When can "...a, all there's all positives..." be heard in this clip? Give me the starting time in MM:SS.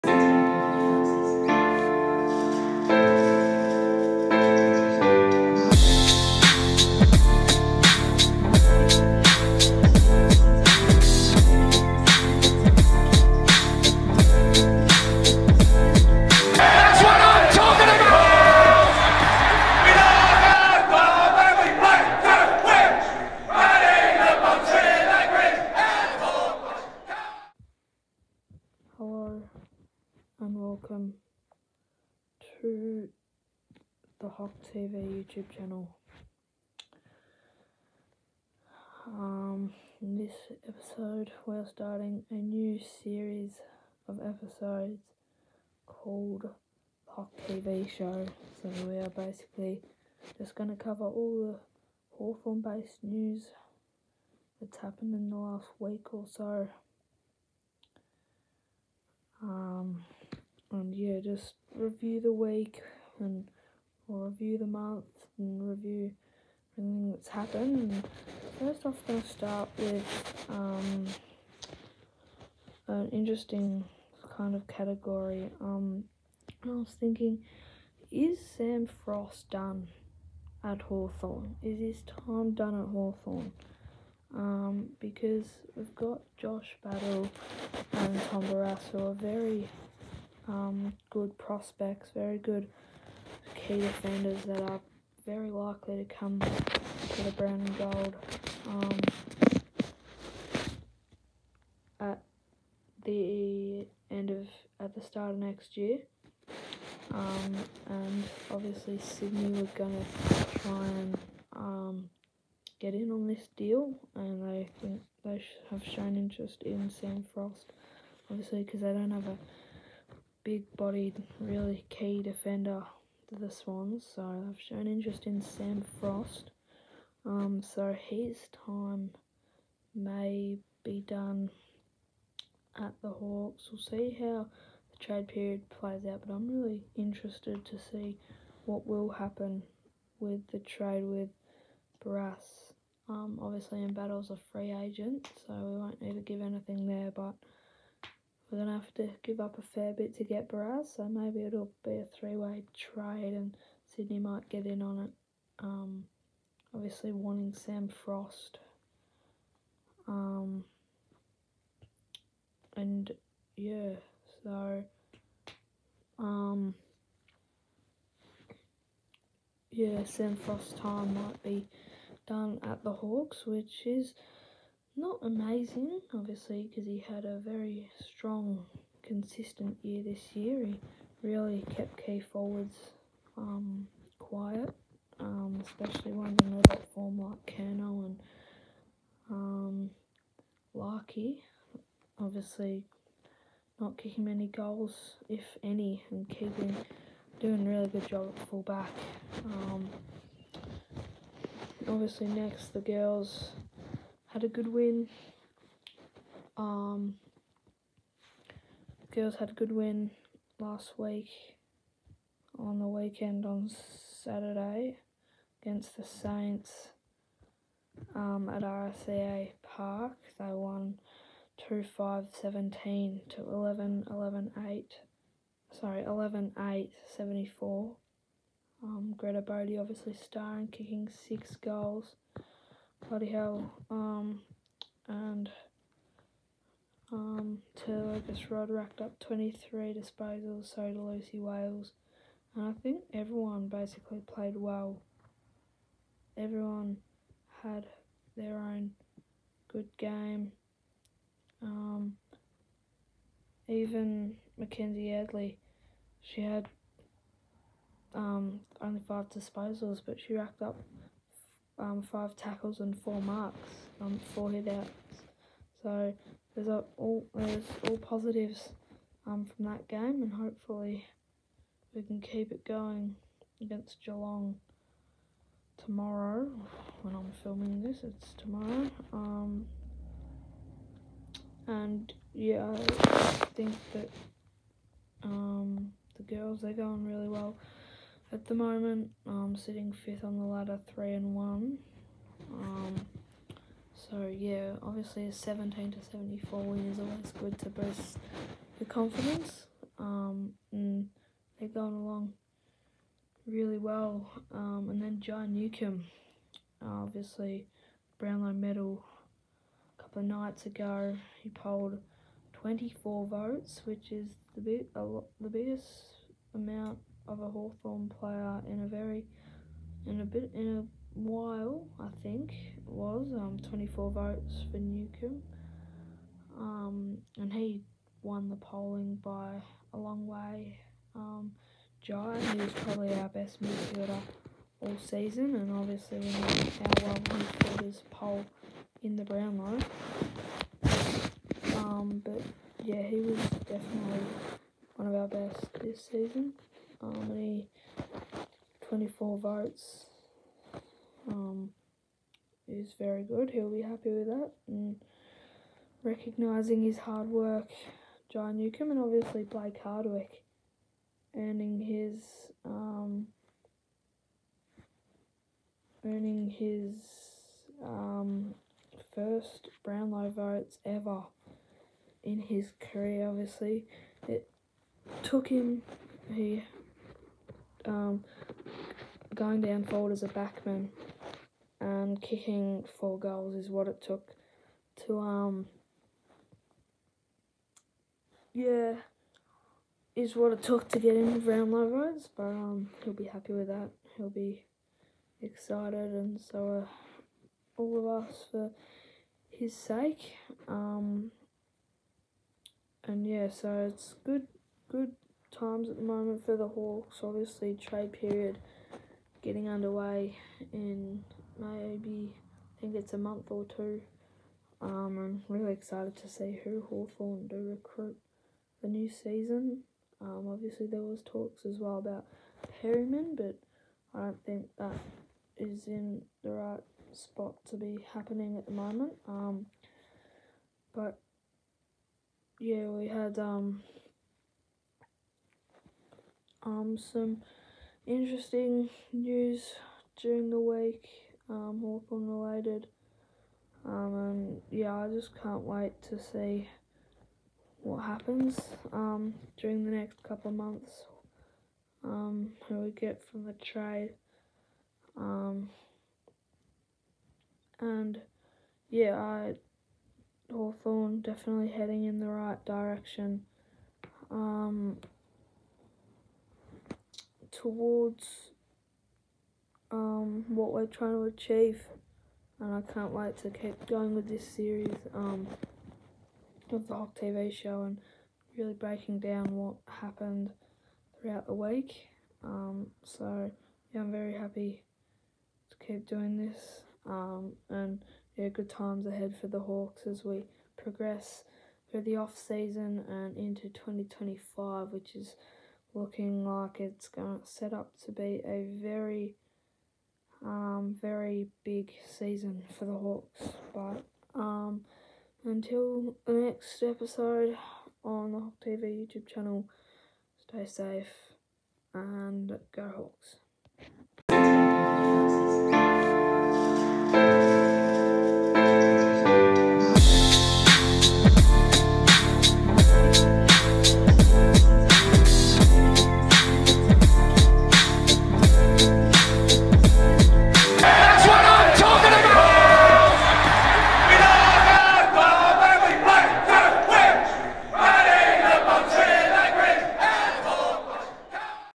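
04:26.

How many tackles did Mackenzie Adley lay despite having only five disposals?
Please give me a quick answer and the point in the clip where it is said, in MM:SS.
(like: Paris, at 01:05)
5, at 04:22.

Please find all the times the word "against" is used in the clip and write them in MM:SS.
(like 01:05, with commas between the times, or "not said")
03:35, 04:33.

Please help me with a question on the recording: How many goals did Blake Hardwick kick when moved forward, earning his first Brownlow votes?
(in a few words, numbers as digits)
4.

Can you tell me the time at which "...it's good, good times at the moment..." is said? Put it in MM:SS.
06:43.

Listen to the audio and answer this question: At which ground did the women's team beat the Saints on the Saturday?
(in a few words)
RSEA Park.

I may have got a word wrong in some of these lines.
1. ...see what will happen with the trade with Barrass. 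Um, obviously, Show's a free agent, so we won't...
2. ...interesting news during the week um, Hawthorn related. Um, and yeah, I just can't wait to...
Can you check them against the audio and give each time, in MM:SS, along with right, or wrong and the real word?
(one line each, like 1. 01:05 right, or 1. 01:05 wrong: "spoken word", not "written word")
1. 02:17 wrong: "Embattle", not "Show"
2. 07:18 right.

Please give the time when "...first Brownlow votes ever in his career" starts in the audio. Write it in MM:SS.
06:09.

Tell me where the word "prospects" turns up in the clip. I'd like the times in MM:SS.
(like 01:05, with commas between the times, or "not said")
01:31.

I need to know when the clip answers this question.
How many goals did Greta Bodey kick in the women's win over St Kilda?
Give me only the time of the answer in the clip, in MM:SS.
03:51.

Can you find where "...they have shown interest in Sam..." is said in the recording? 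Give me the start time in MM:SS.
01:55.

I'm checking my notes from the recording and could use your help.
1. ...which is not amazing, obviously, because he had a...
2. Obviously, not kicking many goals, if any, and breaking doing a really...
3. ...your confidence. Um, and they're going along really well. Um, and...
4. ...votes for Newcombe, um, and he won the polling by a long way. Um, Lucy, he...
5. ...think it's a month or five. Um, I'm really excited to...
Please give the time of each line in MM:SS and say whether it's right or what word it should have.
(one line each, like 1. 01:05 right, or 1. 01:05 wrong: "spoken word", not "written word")
1. 02:53 right
2. 03:12 wrong: "keeping", not "breaking"
3. 04:58 right
4. 05:24 wrong: "Jai", not "Lucy"
5. 06:52 wrong: "two", not "five".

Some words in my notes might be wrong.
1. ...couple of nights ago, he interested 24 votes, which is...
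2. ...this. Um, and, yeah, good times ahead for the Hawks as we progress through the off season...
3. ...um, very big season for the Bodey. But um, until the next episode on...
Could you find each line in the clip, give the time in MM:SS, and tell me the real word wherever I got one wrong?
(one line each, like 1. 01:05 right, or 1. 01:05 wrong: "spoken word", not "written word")
1. 05:10 wrong: "polled", not "interested"
2. 08:06 right
3. 08:20 wrong: "Hawks", not "Bodey".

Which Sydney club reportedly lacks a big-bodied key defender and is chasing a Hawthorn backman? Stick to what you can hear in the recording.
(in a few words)
the Swans.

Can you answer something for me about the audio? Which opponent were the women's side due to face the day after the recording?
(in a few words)
Geelong.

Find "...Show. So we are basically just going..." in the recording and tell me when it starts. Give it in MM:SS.
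00:47.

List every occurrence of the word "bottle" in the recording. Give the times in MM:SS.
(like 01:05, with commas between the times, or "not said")
not said.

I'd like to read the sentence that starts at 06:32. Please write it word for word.
But um, he'll be happy with that.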